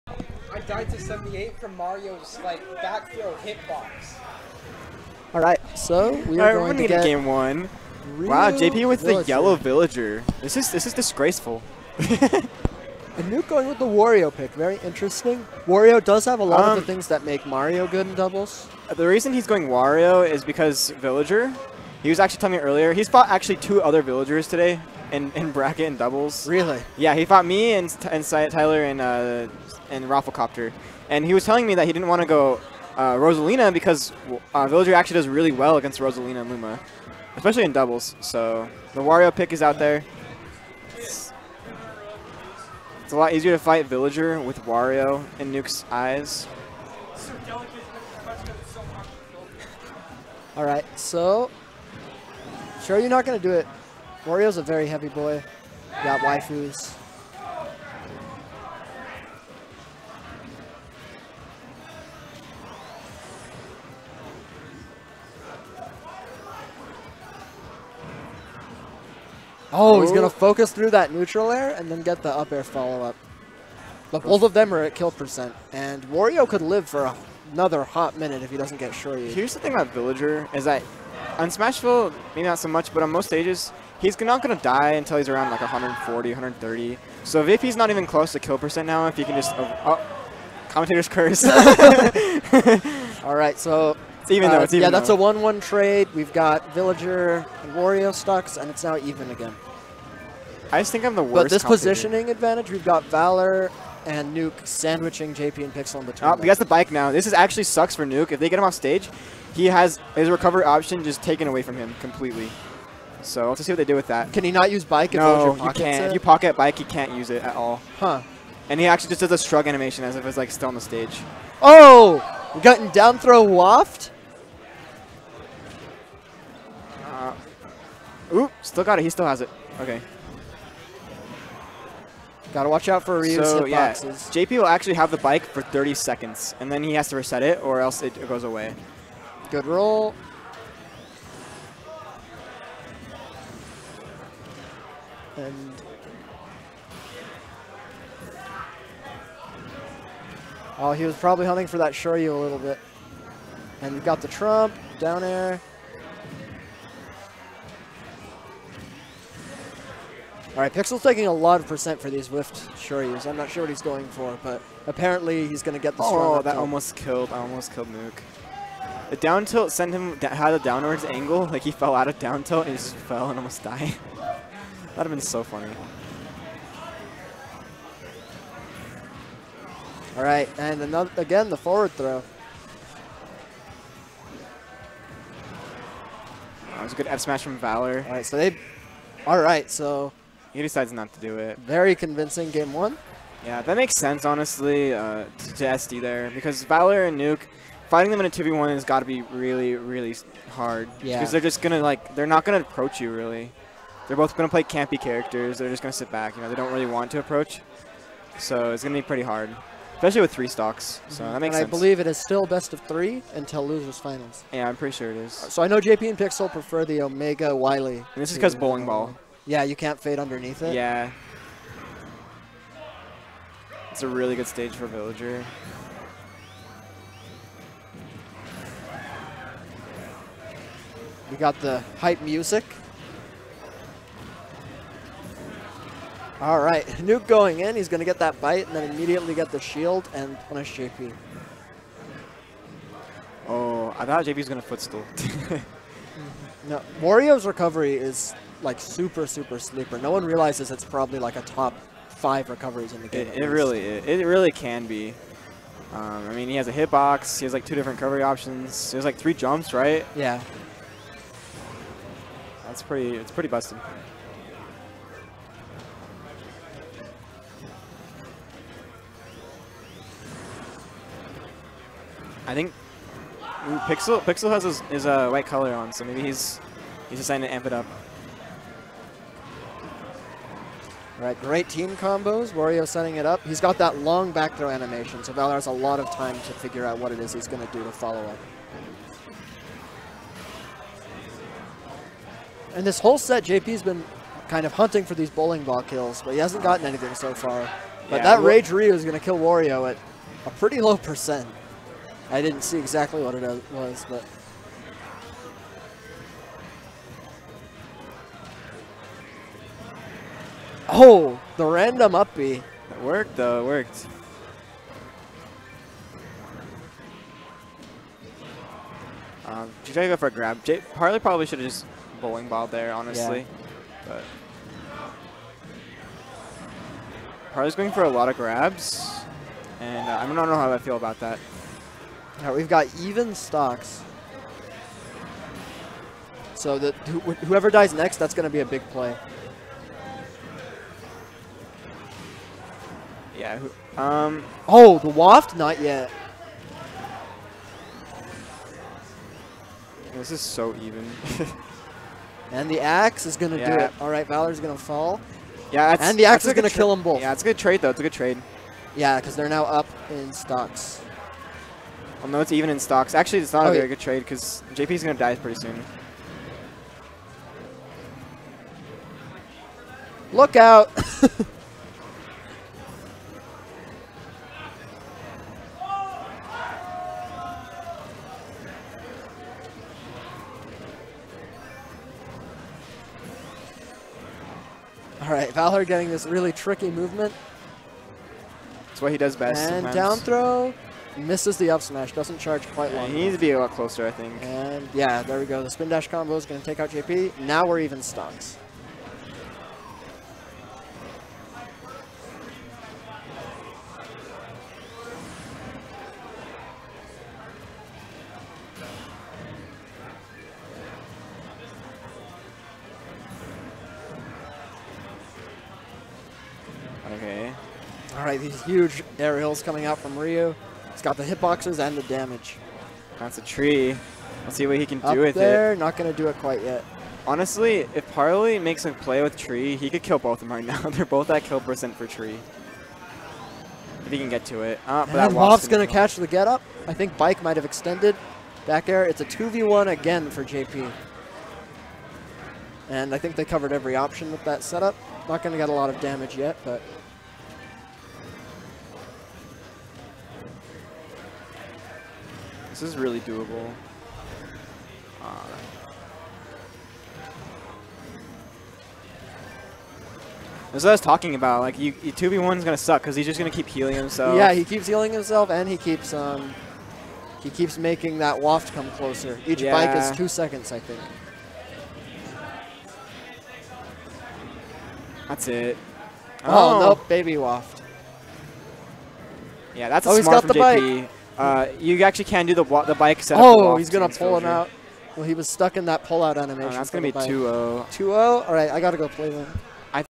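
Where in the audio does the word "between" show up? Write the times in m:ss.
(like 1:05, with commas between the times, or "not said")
1:46.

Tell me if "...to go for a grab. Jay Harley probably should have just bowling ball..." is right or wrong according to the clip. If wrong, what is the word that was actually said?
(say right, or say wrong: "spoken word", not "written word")
right.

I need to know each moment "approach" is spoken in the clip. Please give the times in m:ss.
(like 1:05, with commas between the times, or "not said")
3:22, 3:27.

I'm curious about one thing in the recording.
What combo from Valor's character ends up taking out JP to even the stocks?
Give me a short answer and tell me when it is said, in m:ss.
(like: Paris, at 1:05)
Spin dash combo, at 6:35.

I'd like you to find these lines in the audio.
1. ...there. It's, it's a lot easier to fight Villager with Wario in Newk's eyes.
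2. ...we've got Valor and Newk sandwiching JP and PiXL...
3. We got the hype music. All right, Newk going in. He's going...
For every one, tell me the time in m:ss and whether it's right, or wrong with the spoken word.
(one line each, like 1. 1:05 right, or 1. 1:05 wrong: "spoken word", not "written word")
1. 0:39 right
2. 1:42 right
3. 3:51 right.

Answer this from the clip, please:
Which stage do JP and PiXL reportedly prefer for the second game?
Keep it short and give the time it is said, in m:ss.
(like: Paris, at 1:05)
Omega Wily, at 3:37.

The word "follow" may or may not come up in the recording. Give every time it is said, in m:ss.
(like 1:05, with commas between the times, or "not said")
1:12, 4:47.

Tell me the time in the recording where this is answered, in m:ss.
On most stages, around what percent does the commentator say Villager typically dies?
1:25.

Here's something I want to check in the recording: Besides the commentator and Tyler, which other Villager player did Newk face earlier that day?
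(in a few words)
Rafflecopter.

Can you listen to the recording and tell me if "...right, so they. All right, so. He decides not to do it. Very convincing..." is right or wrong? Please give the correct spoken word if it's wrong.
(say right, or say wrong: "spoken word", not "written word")
right.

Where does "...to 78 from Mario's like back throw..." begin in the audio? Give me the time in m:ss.
0:00.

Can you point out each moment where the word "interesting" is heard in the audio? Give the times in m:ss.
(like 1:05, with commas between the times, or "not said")
0:14.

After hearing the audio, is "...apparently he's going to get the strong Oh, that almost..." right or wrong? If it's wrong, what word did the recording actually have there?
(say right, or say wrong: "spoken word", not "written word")
right.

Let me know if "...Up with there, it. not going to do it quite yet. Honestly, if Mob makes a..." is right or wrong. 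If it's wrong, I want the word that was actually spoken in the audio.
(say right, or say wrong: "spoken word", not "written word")
wrong: "Parley", not "Mob".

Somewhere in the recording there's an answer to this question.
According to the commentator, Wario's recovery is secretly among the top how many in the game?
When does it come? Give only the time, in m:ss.
4:11.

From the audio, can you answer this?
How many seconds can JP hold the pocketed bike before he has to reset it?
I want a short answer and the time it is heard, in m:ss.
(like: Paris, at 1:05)
30, at 2:15.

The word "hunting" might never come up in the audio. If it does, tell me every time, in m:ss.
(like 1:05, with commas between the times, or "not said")
2:31, 4:54.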